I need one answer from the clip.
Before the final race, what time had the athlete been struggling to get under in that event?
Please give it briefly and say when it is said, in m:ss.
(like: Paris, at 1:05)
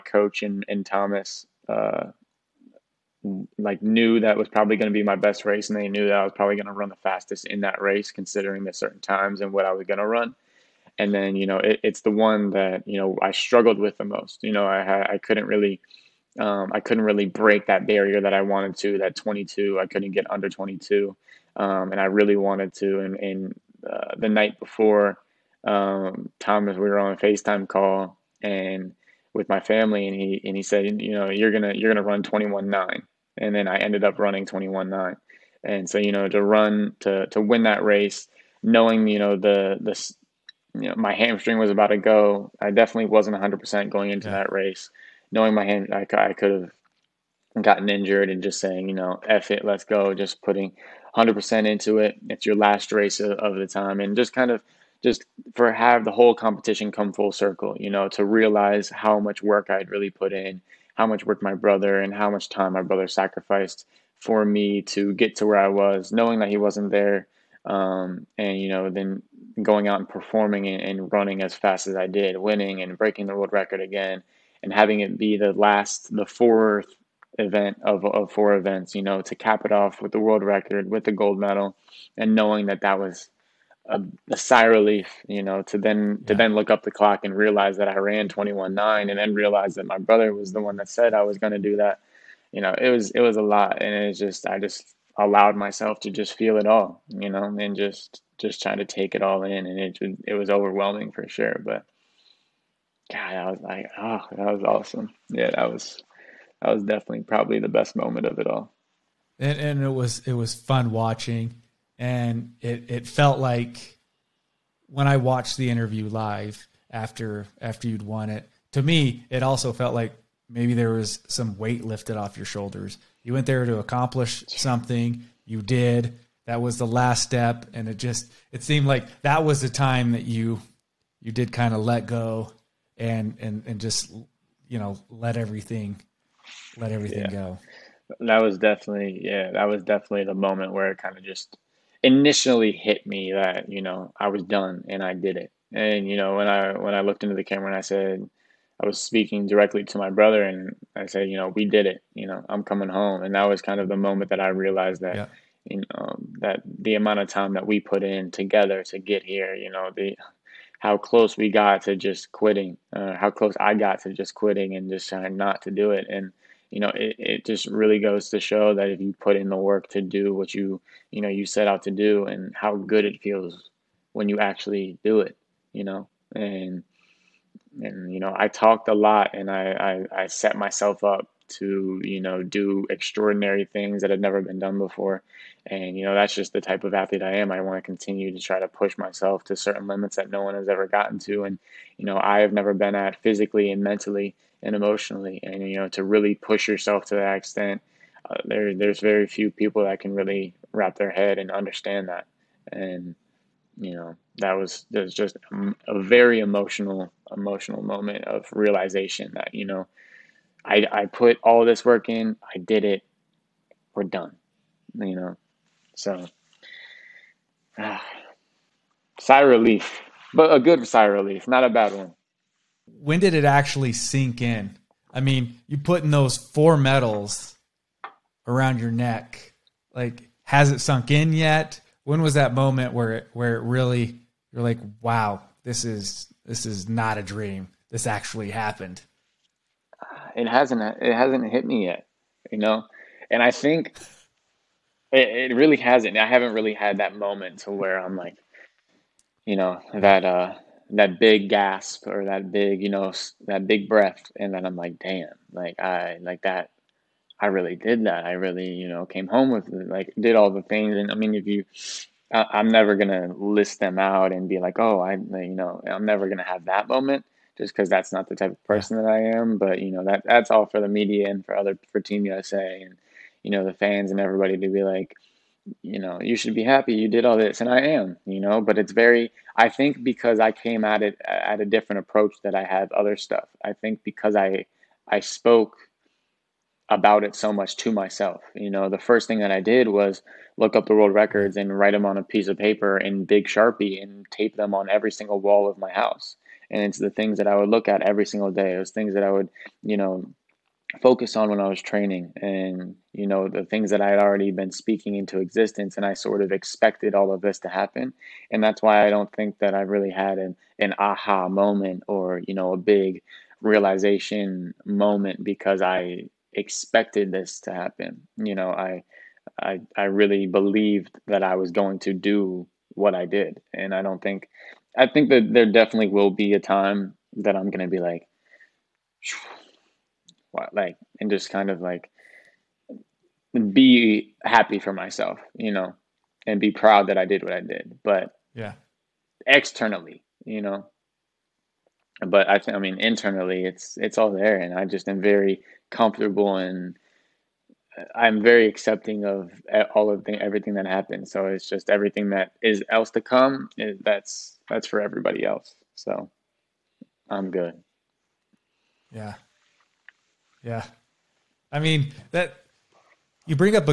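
22, at 0:18.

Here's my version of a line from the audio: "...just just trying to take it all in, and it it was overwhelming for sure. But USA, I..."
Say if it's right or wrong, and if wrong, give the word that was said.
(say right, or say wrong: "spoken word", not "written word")
wrong: "God", not "USA".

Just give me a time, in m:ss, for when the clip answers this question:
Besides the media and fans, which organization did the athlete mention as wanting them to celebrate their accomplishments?
4:31.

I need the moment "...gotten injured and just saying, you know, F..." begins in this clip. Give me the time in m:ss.
0:47.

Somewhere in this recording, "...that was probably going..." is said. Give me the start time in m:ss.
0:04.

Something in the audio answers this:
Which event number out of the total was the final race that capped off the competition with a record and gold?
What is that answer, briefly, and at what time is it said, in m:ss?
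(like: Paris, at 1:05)
the fourth, at 1:16.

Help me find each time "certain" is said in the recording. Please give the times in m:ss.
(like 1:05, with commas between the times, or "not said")
0:08, 3:09.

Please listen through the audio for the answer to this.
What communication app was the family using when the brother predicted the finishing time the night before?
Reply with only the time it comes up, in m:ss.
0:27.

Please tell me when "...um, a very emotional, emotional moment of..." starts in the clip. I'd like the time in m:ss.
3:25.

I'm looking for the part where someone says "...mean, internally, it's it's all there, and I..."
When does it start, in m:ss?
5:42.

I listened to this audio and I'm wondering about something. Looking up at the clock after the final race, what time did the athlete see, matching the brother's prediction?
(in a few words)
21.9.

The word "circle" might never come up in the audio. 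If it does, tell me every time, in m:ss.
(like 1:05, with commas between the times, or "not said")
0:57.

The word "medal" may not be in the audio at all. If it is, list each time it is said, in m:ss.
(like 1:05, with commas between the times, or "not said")
1:21, 3:46.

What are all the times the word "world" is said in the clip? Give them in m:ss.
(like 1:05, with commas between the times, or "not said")
1:13, 1:20, 4:50.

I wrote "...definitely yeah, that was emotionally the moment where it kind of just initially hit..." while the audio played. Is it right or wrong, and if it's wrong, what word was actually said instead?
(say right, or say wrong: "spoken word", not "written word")
wrong: "definitely", not "emotionally".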